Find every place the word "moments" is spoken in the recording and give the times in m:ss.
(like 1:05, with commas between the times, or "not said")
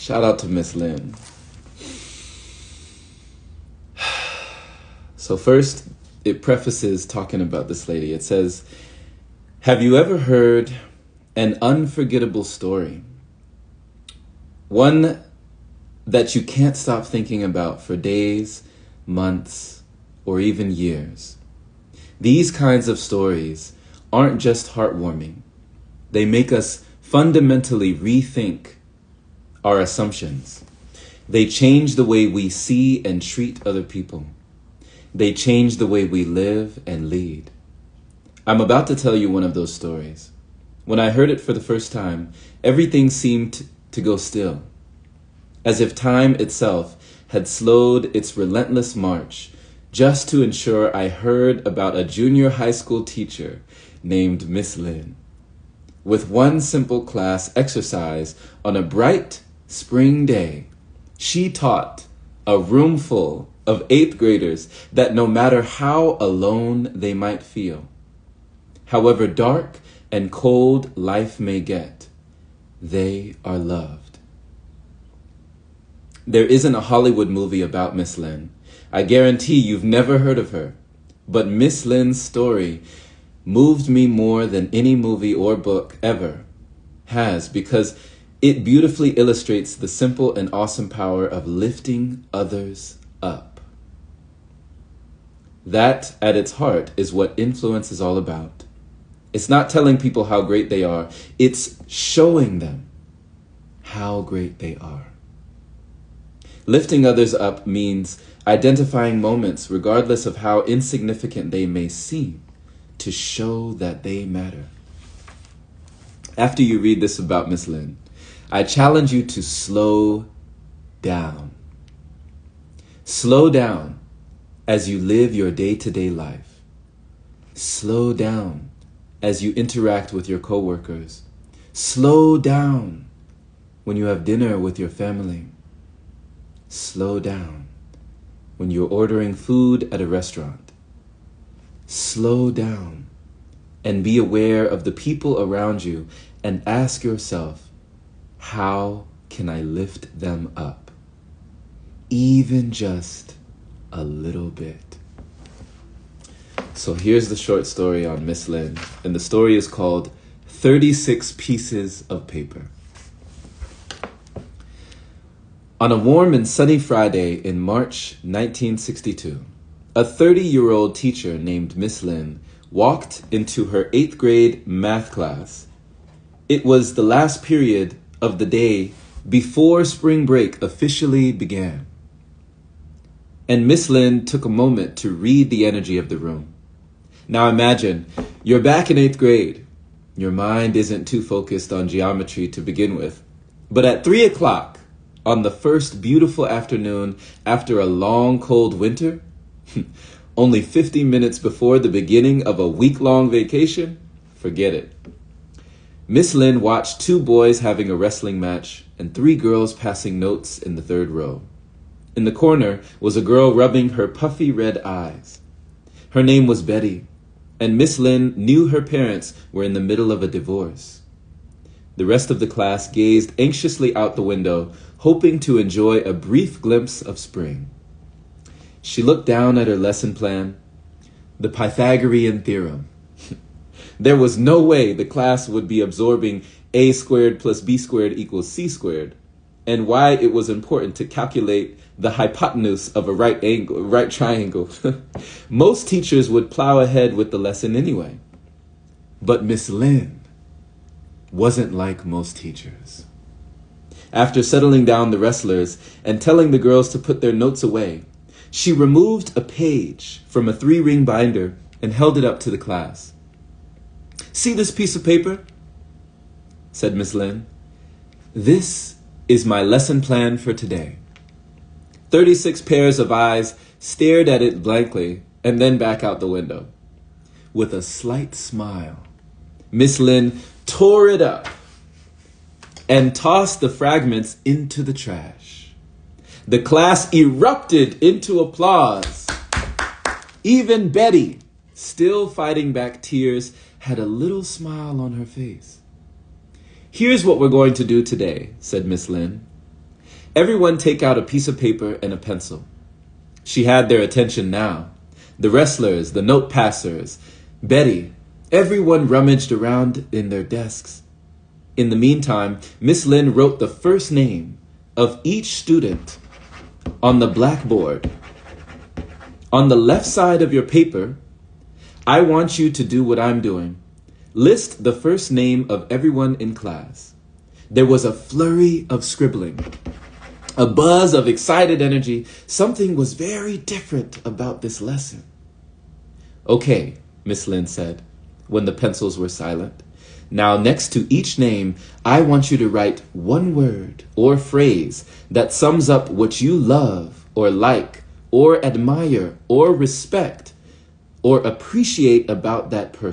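1:49, 3:04.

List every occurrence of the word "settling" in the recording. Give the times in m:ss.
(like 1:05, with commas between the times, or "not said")
4:14.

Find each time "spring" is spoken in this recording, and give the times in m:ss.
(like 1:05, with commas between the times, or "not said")
0:59, 2:59, 3:47.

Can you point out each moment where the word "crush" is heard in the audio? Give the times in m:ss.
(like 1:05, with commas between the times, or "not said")
not said.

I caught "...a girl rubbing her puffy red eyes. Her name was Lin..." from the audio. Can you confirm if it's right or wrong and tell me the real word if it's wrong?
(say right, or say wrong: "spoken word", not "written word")
wrong: "Betty", not "Lin".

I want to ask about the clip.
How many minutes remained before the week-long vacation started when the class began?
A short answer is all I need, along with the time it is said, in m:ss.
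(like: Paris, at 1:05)
50, at 3:20.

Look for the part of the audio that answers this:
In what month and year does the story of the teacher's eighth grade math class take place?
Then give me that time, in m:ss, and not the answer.
2:47.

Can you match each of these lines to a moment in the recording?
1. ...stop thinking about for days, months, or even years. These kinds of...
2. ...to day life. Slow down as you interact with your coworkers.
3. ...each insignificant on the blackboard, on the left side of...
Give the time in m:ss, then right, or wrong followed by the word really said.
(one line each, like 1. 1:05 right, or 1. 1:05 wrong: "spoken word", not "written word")
1. 0:16 right
2. 2:05 right
3. 5:15 wrong: "student", not "insignificant".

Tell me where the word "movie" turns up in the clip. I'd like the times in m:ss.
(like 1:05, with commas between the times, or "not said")
1:17, 1:24.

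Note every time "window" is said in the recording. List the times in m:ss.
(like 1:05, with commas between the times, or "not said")
3:44, 4:36.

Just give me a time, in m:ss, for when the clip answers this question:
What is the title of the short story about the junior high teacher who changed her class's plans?
2:40.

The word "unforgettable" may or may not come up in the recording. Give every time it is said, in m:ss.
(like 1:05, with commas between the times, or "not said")
0:11.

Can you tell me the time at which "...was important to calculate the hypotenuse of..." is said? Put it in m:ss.
4:00.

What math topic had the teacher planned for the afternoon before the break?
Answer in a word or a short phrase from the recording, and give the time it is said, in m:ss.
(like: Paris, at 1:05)
Pythagorean theorem, at 3:51.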